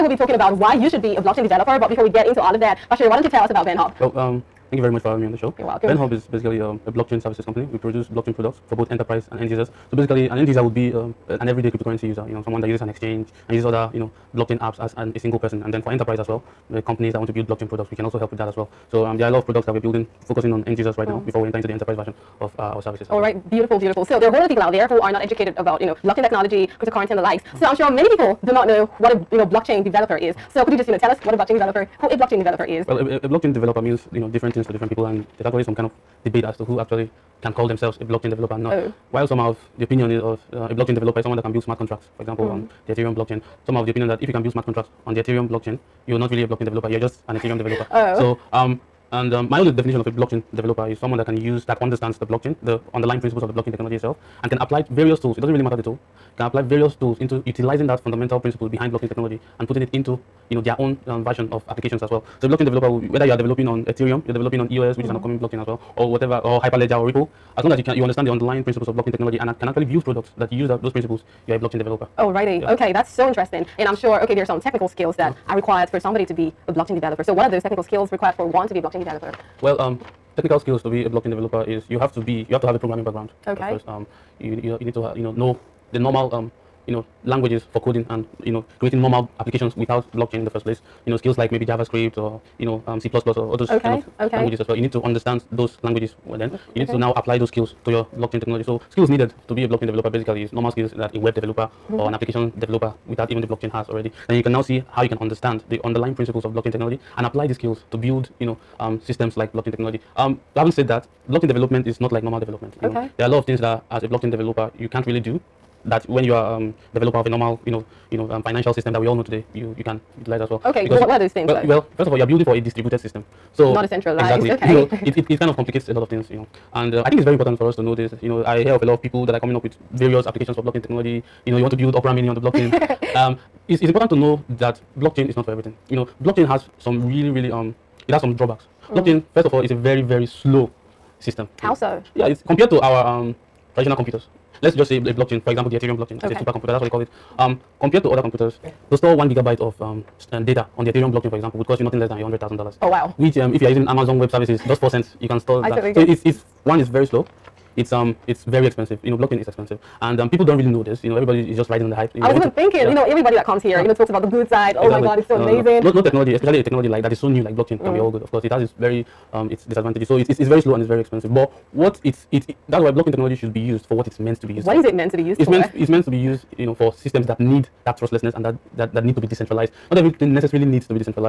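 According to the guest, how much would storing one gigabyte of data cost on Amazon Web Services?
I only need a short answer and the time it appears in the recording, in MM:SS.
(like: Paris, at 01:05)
4 cents, at 02:34.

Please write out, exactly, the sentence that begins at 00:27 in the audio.
Mm So I'm sure many people do not know what a, you know, blockchain developer is.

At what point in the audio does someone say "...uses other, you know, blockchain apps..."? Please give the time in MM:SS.
00:13.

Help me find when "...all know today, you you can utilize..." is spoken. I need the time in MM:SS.
01:59.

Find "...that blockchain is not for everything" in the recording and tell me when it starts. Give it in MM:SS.
02:14.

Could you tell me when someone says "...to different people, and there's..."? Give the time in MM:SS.
00:34.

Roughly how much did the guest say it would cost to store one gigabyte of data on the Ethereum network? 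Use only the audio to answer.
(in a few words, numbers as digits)
$100,000.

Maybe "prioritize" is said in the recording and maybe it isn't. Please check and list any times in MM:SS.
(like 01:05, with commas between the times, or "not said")
not said.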